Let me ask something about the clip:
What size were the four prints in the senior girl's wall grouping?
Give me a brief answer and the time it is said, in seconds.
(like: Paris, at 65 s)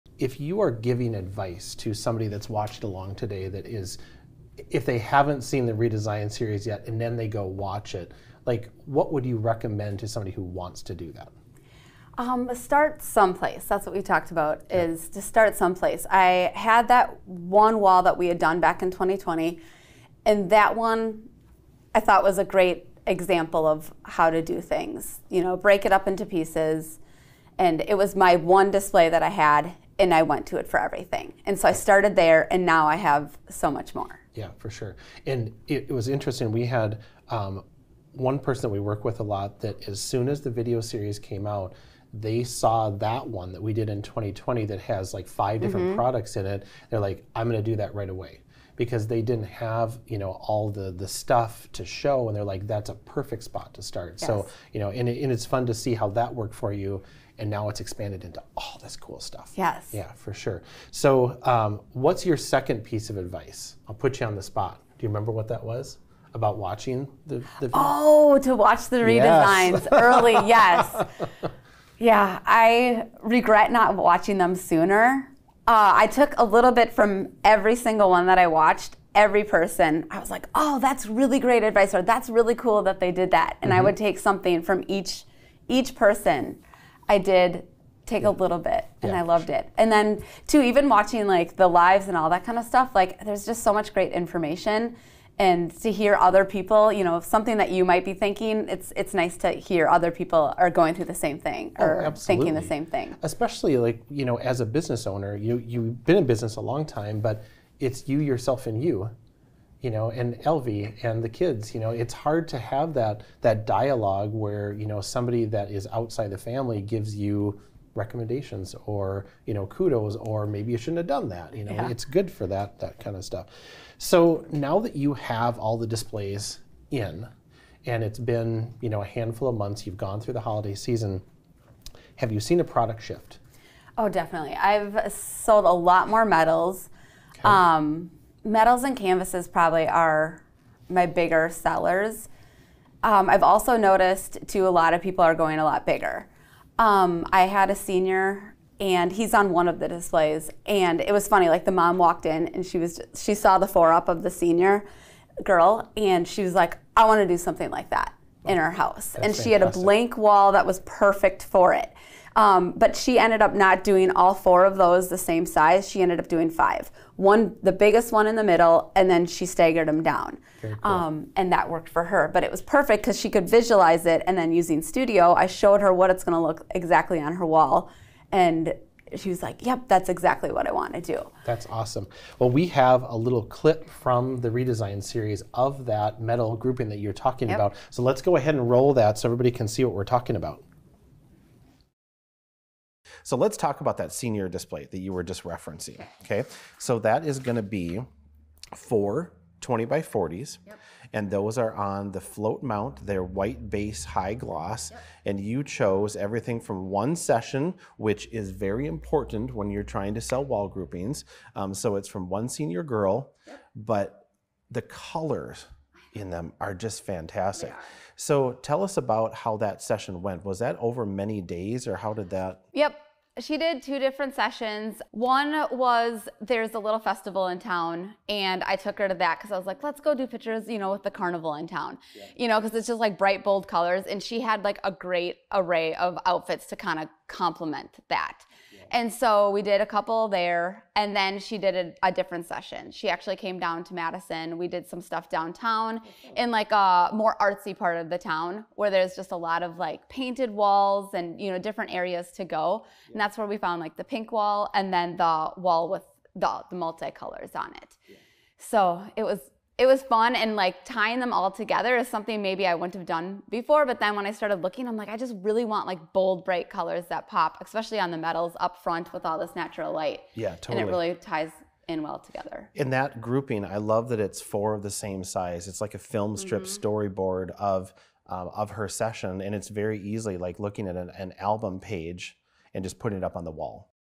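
20 by 40, at 199 s.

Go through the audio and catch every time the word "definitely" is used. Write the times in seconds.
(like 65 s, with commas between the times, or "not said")
134 s.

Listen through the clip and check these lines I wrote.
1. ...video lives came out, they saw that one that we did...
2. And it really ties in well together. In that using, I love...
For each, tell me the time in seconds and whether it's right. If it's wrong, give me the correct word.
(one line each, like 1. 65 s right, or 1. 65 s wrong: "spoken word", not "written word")
1. 40 s wrong: "series", not "lives"
2. 270 s wrong: "grouping", not "using".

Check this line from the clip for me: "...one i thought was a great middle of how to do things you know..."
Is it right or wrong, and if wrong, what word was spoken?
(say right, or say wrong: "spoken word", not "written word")
wrong: "example", not "middle".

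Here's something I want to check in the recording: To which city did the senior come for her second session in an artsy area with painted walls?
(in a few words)
Madison.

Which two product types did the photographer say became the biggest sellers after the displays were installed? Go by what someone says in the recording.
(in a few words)
Metals and canvases.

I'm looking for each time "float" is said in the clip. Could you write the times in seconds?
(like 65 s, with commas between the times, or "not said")
202 s.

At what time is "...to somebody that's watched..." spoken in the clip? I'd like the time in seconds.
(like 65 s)
1 s.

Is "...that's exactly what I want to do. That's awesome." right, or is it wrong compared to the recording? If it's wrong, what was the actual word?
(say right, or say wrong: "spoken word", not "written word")
right.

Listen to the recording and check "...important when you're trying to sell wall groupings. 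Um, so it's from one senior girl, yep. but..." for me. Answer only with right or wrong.
right.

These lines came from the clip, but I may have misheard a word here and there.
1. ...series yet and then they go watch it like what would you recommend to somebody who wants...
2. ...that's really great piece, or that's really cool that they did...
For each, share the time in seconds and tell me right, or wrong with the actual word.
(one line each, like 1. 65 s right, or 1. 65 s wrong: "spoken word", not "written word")
1. 6 s right
2. 80 s wrong: "advice", not "piece".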